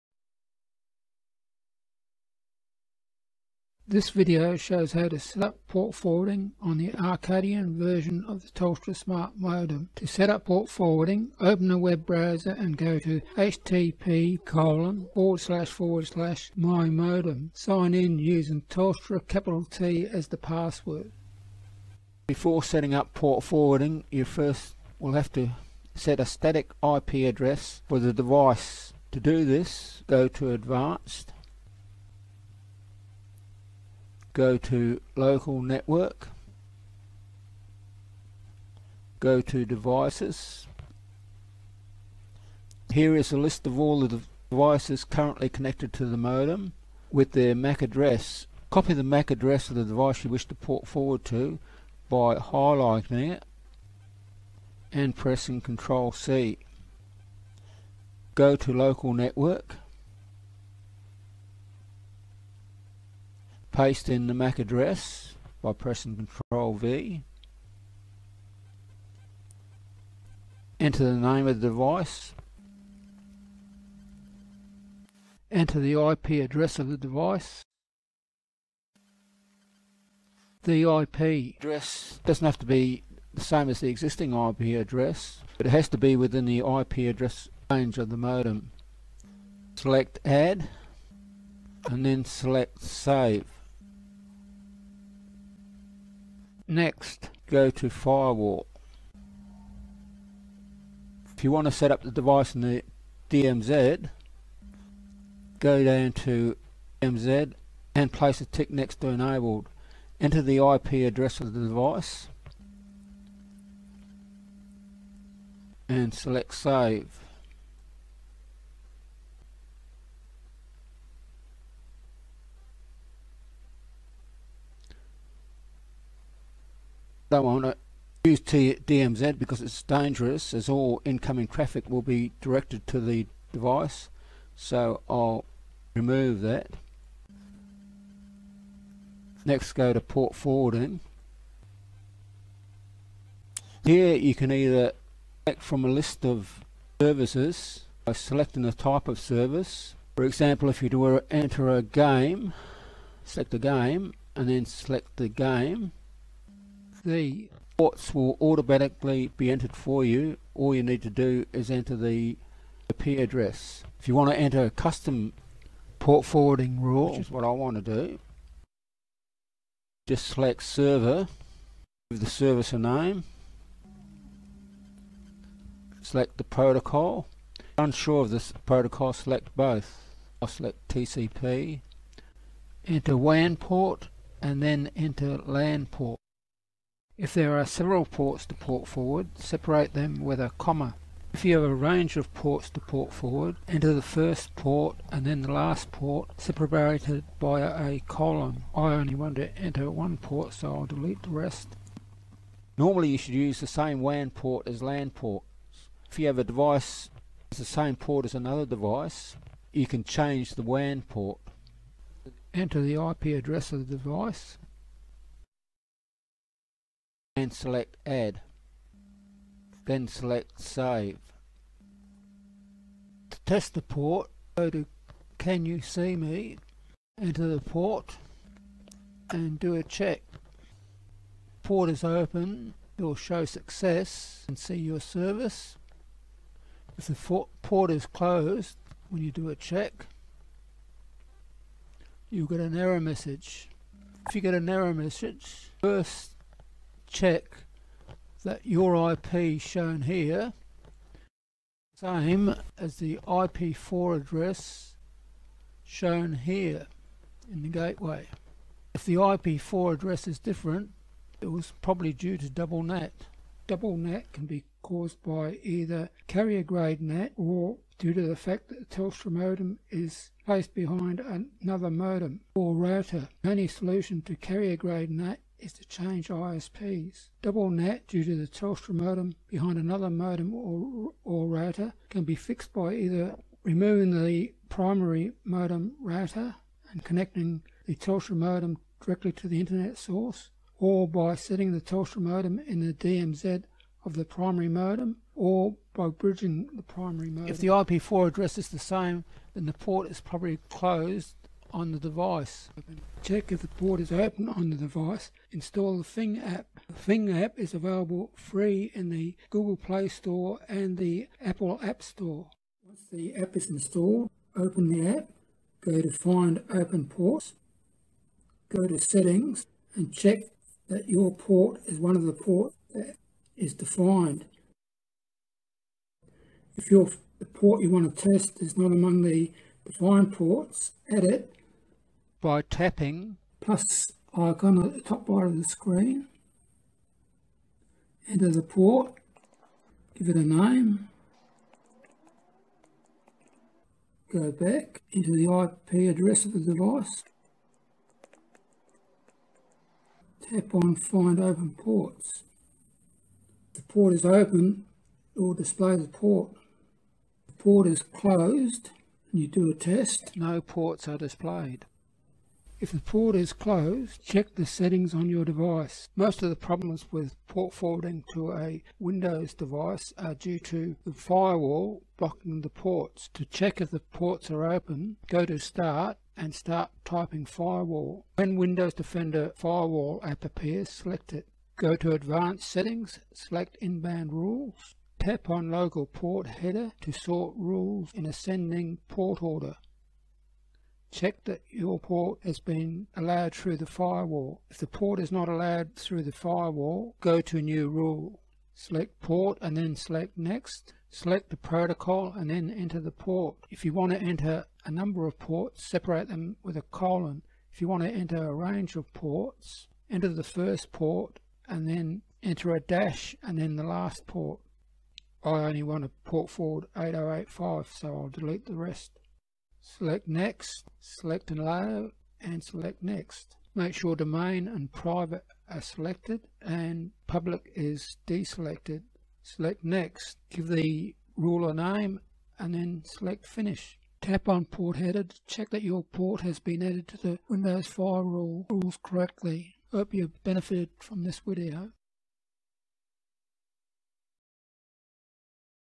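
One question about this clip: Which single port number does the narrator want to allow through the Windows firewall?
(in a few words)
8085.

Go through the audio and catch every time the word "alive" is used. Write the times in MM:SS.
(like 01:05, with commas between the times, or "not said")
not said.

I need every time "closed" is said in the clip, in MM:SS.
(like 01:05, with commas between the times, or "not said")
03:58, 05:00, 05:58, 06:03.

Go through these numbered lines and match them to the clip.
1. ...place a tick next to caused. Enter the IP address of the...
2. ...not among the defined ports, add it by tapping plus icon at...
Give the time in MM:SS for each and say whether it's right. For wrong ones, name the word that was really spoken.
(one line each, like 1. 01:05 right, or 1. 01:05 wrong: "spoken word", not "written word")
1. 01:48 wrong: "enabled", not "caused"
2. 05:28 right.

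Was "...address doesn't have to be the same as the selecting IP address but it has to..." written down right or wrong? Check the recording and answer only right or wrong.
wrong.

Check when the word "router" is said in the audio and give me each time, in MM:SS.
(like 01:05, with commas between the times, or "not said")
04:32, 04:41, 04:46.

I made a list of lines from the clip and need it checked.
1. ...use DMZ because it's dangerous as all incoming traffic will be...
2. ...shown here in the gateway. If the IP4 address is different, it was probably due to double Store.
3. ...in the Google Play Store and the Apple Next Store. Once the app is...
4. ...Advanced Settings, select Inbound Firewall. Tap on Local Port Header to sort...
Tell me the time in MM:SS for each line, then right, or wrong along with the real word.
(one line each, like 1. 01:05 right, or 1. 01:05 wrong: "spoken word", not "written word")
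1. 02:08 right
2. 04:15 wrong: "NAT", not "Store"
3. 05:08 wrong: "App", not "Next"
4. 06:22 wrong: "Rules", not "Firewall".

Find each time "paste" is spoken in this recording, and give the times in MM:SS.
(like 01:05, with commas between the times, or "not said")
01:03.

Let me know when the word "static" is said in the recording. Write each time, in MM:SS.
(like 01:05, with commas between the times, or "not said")
00:26.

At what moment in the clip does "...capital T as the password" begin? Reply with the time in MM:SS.
00:19.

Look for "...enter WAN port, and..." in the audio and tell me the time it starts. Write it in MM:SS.
03:02.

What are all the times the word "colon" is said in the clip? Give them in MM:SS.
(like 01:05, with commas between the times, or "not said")
00:14, 03:18, 06:46.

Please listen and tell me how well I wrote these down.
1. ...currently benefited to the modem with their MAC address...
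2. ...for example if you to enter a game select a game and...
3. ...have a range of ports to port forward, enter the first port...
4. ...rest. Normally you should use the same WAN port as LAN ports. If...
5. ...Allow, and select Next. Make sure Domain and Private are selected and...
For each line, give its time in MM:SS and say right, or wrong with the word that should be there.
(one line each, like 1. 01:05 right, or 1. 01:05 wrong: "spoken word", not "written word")
1. 00:45 wrong: "connected", not "benefited"
2. 02:30 right
3. 03:11 right
4. 03:21 right
5. 07:01 right.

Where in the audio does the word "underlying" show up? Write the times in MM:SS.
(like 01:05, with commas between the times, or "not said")
not said.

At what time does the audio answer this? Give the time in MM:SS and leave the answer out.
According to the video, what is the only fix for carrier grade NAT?
04:35.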